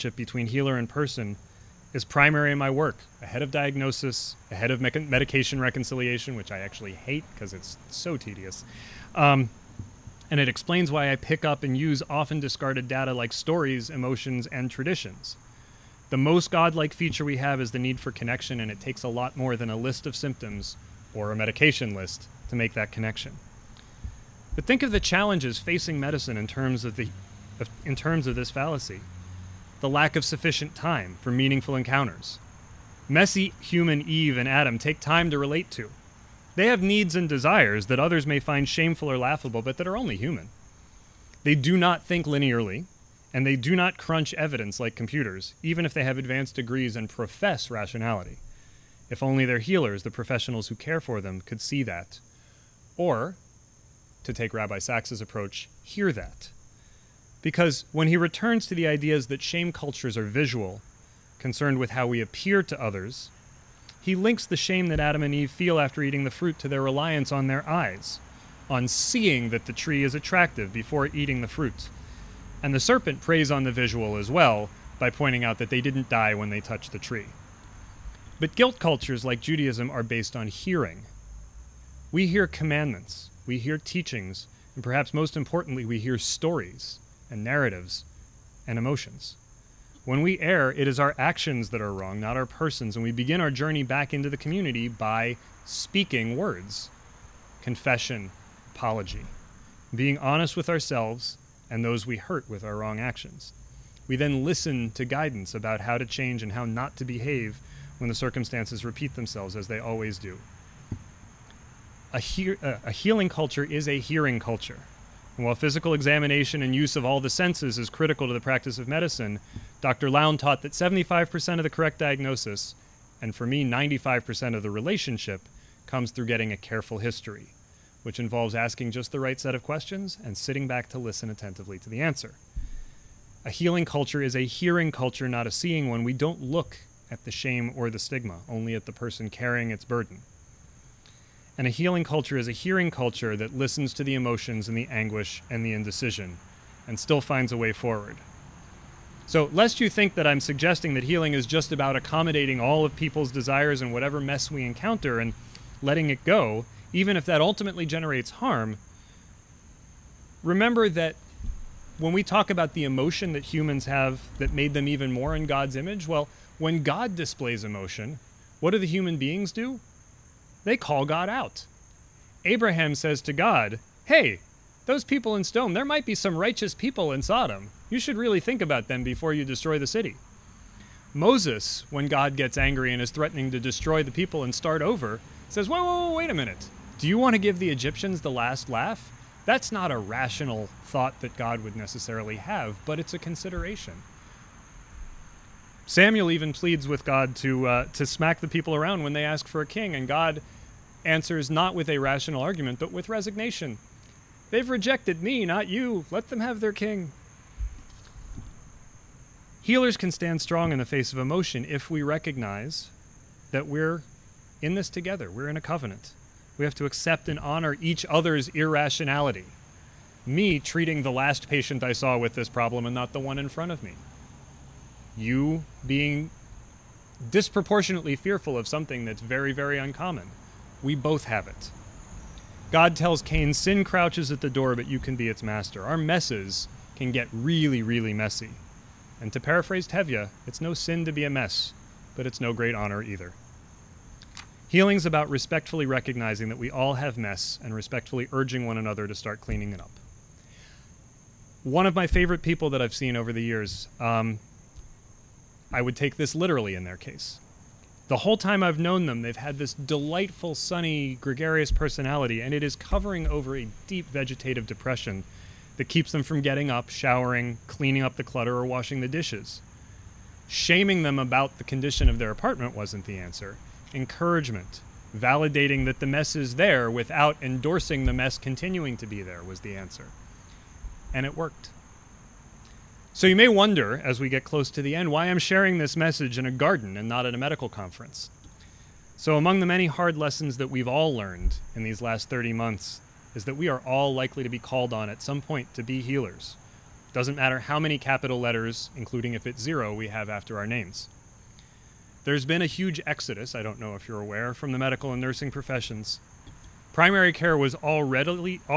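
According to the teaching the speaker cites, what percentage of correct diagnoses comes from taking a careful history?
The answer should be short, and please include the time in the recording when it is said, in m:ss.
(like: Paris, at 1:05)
75%, at 2:00.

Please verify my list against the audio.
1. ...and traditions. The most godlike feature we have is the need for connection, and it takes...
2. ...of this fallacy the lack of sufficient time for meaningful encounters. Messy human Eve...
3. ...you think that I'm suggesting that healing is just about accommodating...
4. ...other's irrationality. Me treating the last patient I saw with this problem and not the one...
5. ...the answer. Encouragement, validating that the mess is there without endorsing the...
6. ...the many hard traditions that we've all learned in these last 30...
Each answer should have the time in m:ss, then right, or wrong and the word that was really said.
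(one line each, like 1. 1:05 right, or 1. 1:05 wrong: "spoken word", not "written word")
1. 0:14 right
2. 0:28 right
3. 2:29 right
4. 3:38 right
5. 4:33 right
6. 4:49 wrong: "lessons", not "traditions".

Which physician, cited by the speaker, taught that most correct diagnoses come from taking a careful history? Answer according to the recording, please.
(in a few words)
Dr. Lown.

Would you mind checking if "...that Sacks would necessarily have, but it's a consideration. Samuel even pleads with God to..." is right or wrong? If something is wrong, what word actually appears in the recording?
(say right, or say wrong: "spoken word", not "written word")
wrong: "God", not "Sacks".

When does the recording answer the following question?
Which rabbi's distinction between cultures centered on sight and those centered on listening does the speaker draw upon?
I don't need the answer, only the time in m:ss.
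0:54.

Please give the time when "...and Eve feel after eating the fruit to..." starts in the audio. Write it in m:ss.
1:05.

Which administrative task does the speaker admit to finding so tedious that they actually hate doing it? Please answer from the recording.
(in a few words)
Medication reconciliation.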